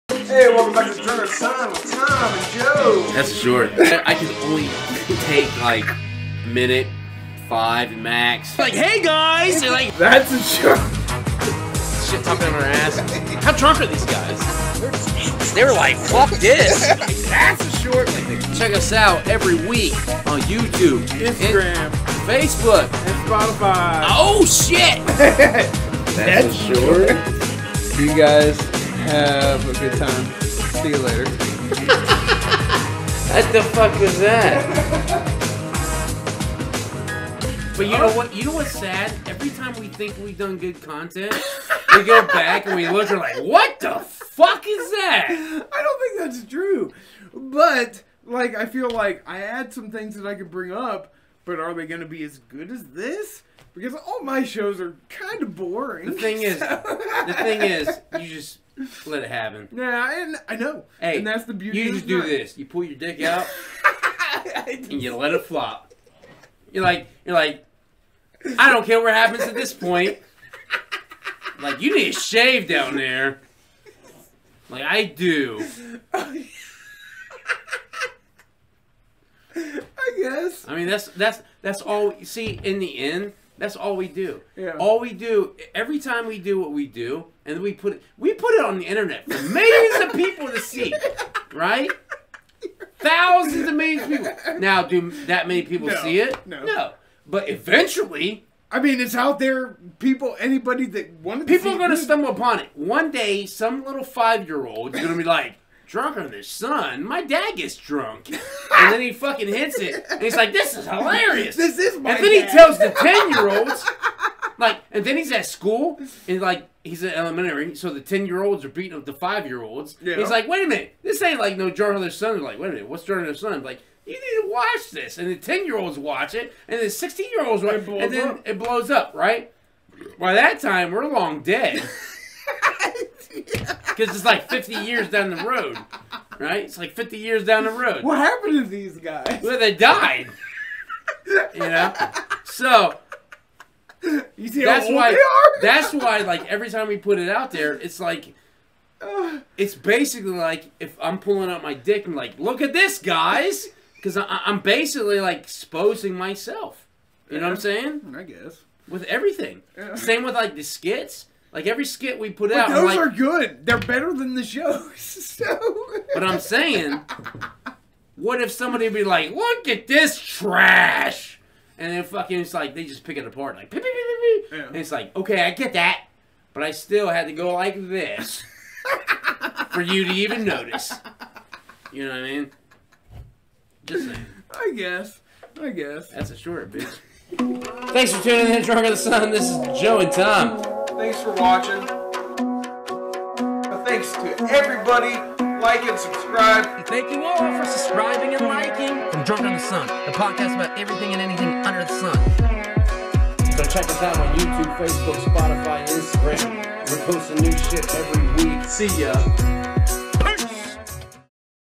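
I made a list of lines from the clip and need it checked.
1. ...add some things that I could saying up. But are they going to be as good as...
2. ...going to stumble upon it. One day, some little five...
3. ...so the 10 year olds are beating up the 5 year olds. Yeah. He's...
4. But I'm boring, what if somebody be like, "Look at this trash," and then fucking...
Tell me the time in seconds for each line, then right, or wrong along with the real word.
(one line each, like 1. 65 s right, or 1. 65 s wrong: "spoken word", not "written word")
1. 49 s wrong: "bring", not "saying"
2. 101 s right
3. 117 s right
4. 166 s wrong: "saying", not "boring".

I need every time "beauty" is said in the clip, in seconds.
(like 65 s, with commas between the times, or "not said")
61 s.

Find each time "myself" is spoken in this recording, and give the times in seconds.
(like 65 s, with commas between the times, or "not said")
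156 s.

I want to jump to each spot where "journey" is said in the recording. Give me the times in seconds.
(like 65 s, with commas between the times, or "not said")
not said.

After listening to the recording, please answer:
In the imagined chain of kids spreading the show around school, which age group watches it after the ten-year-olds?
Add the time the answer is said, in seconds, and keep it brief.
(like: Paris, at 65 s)
16 year olds, at 126 s.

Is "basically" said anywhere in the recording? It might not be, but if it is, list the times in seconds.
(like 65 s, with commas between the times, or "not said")
149 s, 154 s.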